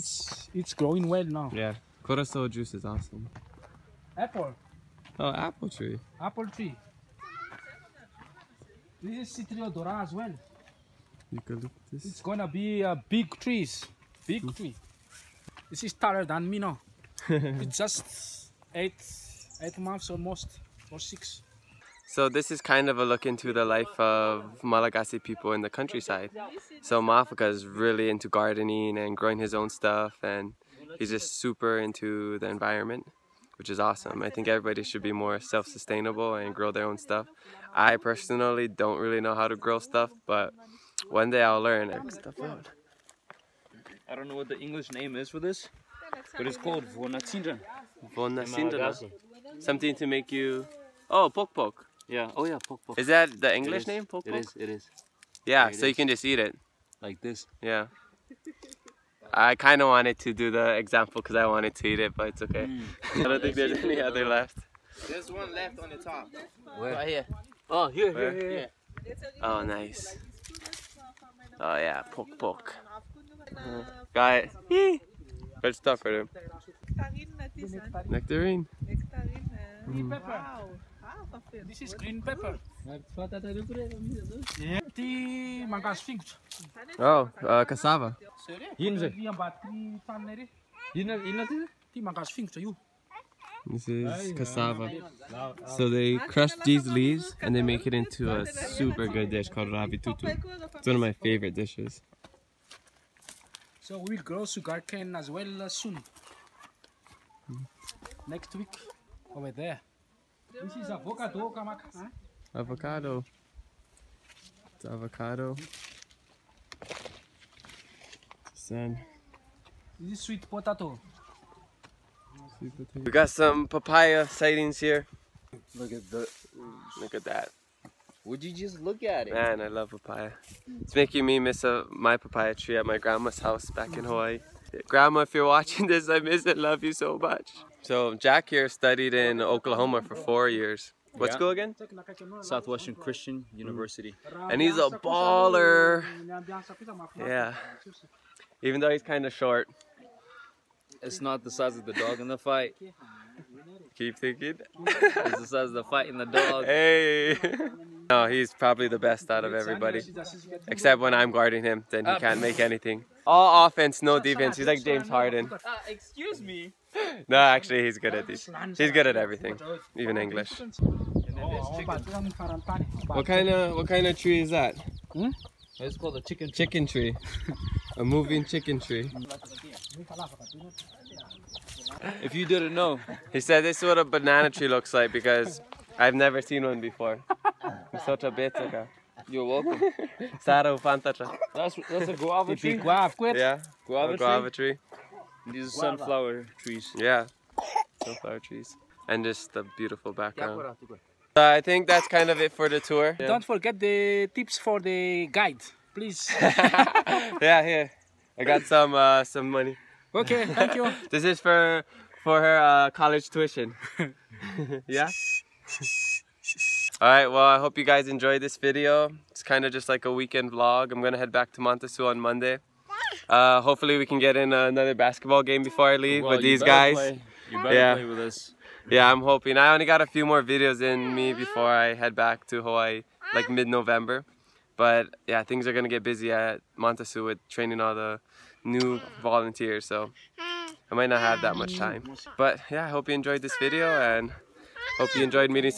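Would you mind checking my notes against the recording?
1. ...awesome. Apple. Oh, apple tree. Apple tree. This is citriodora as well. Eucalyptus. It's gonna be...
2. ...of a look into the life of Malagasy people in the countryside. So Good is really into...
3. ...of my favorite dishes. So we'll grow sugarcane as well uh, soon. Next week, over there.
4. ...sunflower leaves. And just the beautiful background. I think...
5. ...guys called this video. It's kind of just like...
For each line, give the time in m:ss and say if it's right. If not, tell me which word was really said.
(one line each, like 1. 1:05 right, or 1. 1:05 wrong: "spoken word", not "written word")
1. 0:02 right
2. 0:22 wrong: "Mafaka", not "Good"
3. 1:40 right
4. 3:18 wrong: "trees", not "leaves"
5. 3:37 wrong: "enjoyed", not "called".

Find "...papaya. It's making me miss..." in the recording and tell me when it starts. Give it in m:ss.
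2:09.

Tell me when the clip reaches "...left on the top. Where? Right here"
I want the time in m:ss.
1:05.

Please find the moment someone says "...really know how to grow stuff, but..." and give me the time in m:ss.
0:38.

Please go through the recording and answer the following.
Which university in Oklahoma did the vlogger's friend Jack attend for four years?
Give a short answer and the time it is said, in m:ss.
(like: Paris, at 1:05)
Southwestern Christian University, at 2:22.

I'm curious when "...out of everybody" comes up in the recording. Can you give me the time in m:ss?
2:39.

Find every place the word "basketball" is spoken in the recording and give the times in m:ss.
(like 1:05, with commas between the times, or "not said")
3:44.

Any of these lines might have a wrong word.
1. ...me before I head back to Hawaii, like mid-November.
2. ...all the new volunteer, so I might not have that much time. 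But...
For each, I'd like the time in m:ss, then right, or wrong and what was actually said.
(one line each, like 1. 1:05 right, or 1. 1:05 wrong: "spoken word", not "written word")
1. 3:51 right
2. 3:57 right.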